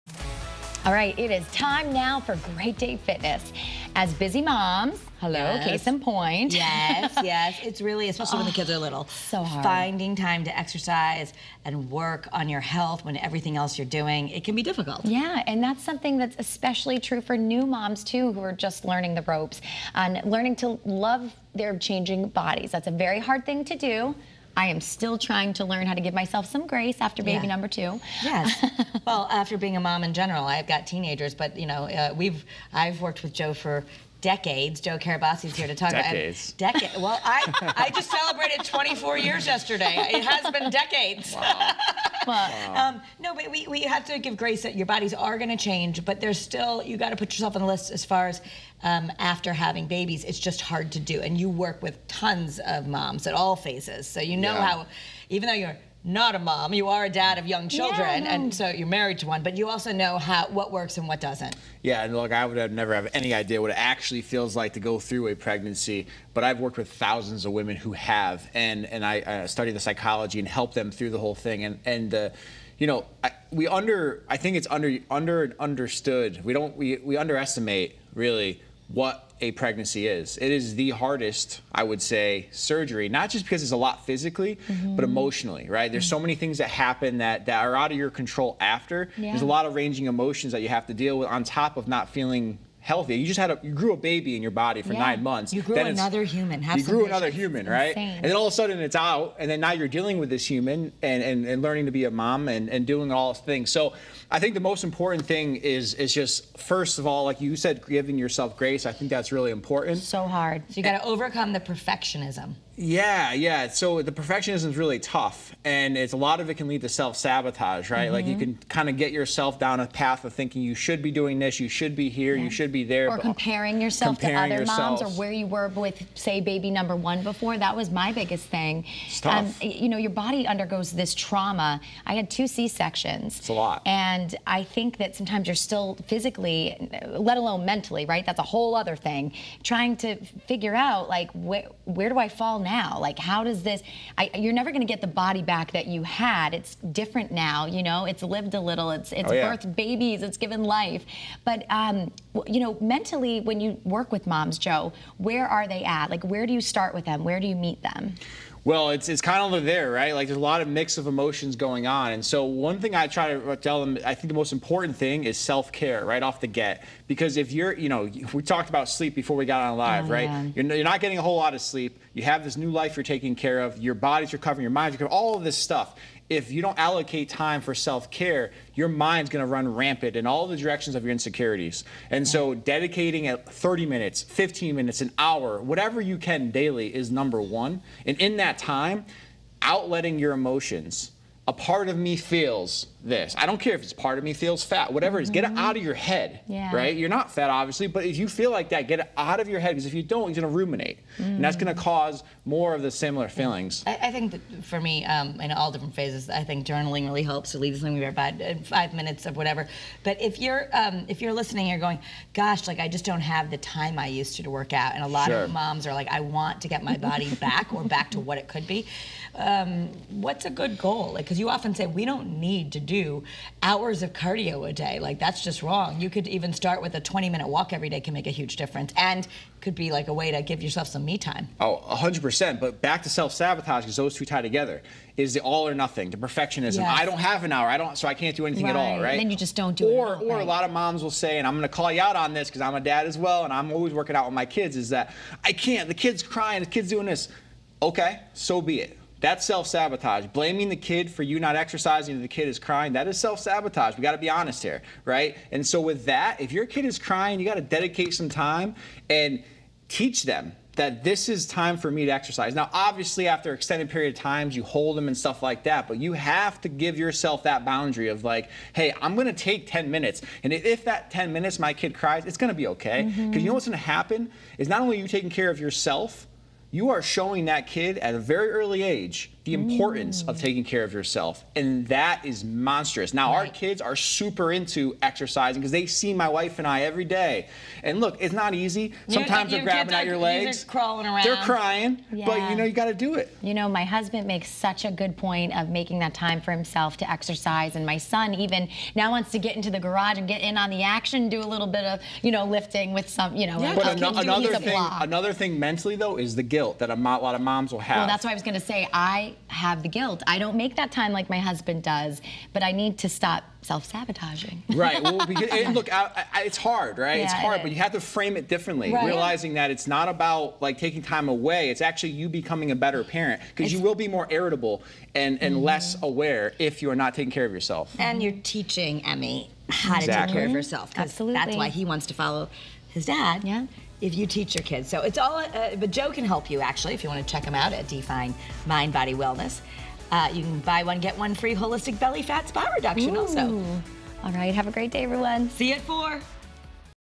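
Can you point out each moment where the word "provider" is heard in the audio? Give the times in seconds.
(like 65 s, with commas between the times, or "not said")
not said.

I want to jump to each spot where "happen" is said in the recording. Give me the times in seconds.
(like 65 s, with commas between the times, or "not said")
86 s, 273 s.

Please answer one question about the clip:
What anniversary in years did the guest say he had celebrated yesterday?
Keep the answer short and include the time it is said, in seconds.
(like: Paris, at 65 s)
24 years, at 38 s.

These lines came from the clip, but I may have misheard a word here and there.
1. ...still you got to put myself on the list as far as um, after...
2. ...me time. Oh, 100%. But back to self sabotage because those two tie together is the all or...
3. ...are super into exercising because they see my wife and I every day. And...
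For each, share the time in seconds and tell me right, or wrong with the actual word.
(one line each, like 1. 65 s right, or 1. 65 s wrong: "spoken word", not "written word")
1. 46 s wrong: "yourself", not "myself"
2. 231 s right
3. 283 s right.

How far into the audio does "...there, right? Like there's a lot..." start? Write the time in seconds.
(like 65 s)
159 s.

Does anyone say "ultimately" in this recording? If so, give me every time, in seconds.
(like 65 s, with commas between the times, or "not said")
not said.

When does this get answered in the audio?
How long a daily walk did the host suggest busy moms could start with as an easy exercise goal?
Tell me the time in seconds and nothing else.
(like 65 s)
227 s.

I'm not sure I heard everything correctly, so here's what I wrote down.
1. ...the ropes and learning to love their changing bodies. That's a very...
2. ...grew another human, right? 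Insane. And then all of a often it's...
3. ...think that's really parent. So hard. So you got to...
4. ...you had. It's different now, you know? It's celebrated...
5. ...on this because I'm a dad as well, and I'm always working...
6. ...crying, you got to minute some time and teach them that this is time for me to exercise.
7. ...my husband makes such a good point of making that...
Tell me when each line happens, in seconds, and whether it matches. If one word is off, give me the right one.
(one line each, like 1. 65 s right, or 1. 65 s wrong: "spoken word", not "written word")
1. 19 s right
2. 96 s wrong: "sudden", not "often"
3. 108 s wrong: "important", not "parent"
4. 145 s wrong: "lived", not "celebrated"
5. 242 s right
6. 256 s wrong: "dedicate", not "minute"
7. 293 s right.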